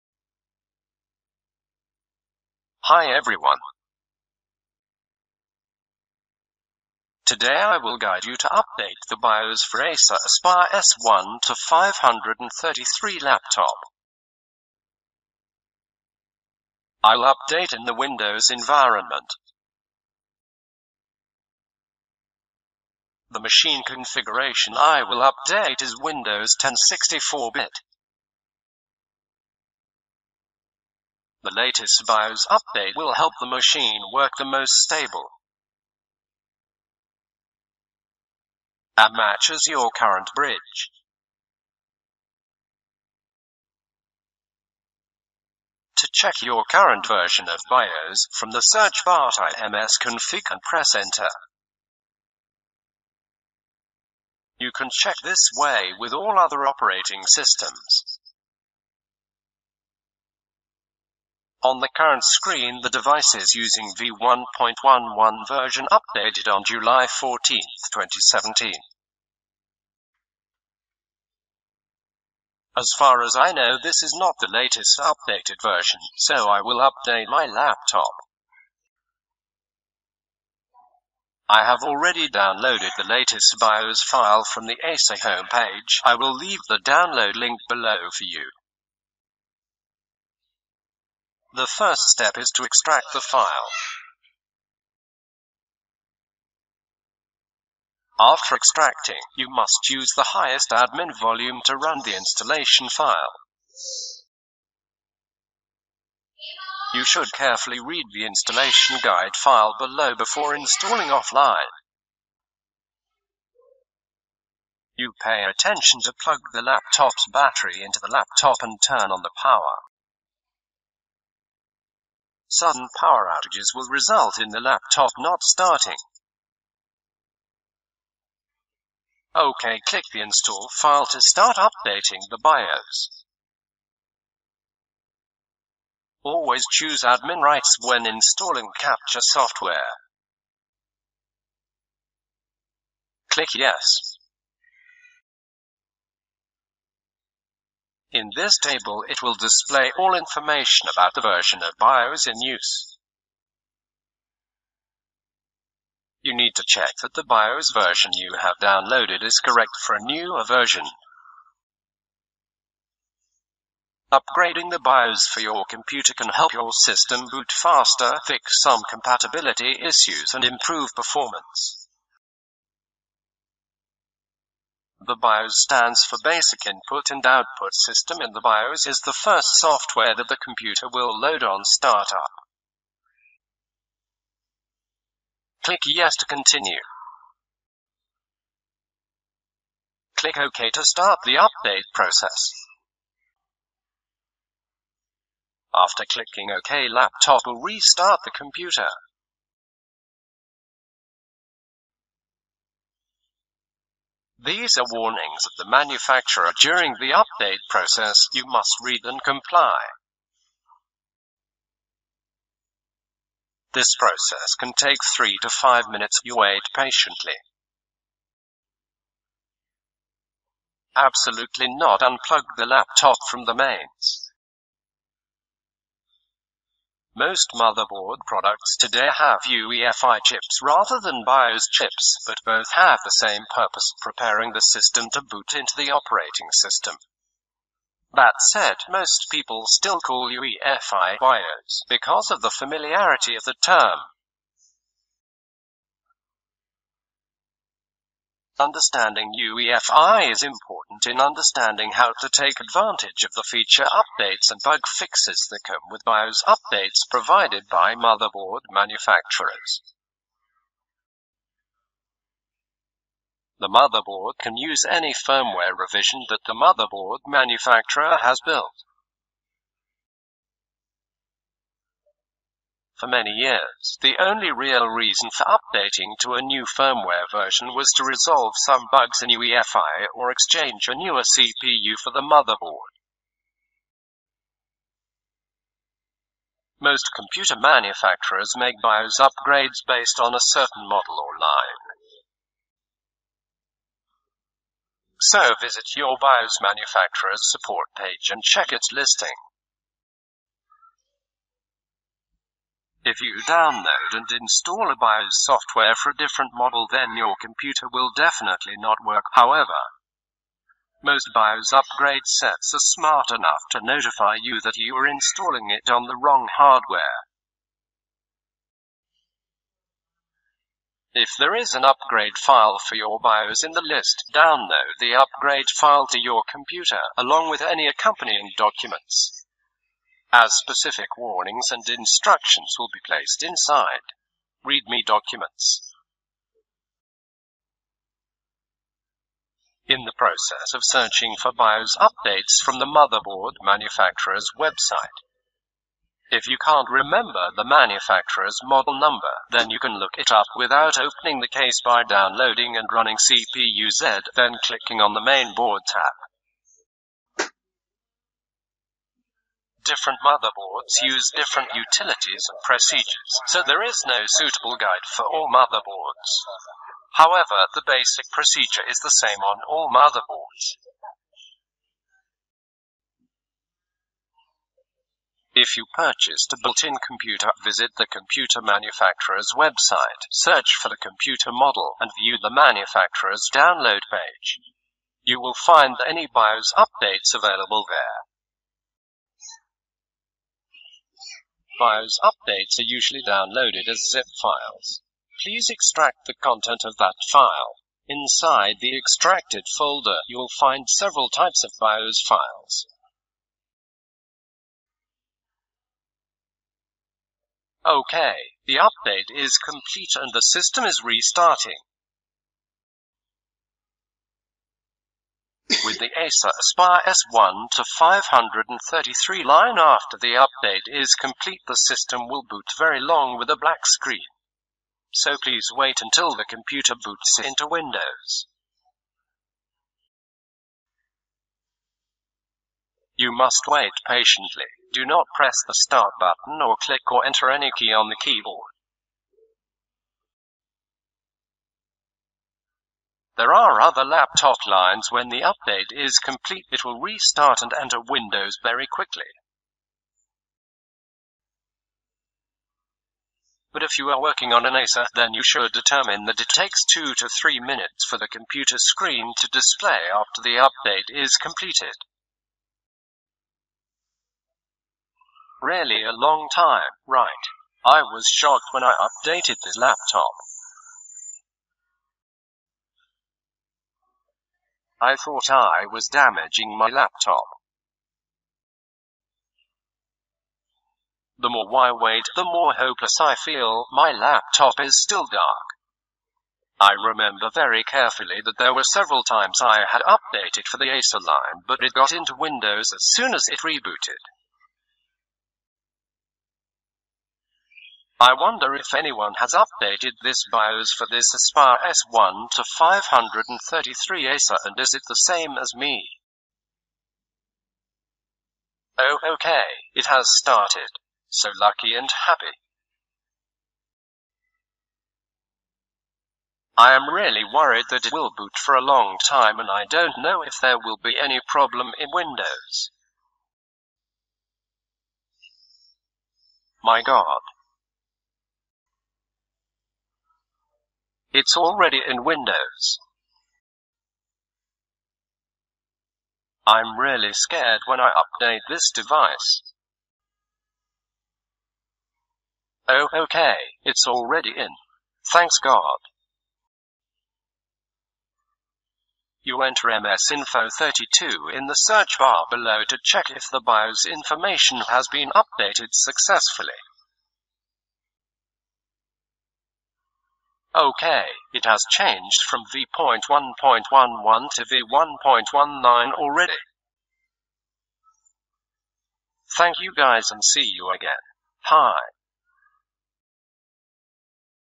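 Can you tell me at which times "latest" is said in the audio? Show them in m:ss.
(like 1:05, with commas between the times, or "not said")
0:31, 1:14, 1:23.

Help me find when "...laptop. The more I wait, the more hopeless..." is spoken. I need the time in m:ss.
7:56.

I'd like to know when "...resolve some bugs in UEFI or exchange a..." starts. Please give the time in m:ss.
4:38.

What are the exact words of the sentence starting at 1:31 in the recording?
The first step is to extract the file.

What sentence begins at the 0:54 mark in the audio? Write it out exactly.
You can check this way with all other operating systems.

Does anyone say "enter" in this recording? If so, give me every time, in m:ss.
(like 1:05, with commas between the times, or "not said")
0:50, 7:17, 7:27, 9:09.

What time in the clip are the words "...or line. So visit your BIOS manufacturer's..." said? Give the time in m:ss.
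4:51.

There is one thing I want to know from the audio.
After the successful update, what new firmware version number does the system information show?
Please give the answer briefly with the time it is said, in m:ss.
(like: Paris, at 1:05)
v1.19, at 9:24.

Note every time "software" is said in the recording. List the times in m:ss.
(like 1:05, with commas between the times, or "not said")
2:19, 2:59, 5:05.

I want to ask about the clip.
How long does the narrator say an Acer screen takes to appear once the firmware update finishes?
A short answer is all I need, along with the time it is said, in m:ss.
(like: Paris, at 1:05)
2 to 3 minutes, at 7:36.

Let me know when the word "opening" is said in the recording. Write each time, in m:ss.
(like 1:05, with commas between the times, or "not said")
5:50.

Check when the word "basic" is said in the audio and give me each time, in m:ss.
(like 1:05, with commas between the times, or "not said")
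2:56, 6:07.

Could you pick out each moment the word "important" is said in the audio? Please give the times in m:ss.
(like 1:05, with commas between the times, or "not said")
4:10.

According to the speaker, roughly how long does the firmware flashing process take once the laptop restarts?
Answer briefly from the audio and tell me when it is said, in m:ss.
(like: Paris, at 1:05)
3 to 5 minutes, at 3:35.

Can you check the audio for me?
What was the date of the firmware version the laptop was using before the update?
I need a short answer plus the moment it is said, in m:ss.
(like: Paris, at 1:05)
July 14, 2017, at 1:06.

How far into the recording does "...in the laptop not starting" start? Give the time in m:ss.
2:04.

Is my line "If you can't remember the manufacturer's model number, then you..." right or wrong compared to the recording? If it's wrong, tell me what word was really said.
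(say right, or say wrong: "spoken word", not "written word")
right.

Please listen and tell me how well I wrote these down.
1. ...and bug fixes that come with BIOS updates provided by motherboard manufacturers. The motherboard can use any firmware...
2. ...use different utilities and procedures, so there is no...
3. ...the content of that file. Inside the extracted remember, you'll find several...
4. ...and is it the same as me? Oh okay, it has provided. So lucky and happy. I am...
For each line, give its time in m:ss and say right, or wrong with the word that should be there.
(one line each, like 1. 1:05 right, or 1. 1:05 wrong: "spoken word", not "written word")
1. 4:14 right
2. 6:01 right
3. 6:36 wrong: "folder", not "remember"
4. 8:24 wrong: "started", not "provided".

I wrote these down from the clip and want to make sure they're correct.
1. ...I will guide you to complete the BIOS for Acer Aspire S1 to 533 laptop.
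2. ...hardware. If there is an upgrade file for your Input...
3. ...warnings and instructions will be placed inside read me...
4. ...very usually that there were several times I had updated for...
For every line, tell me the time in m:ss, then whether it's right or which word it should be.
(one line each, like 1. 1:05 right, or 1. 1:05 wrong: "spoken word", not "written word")
1. 0:07 wrong: "update", not "complete"
2. 5:16 wrong: "BIOS", not "Input"
3. 5:31 right
4. 8:07 wrong: "carefully", not "usually".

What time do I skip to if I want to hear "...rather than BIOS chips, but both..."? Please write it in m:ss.
3:50.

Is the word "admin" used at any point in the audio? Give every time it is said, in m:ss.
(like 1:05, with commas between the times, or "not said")
1:40, 2:17.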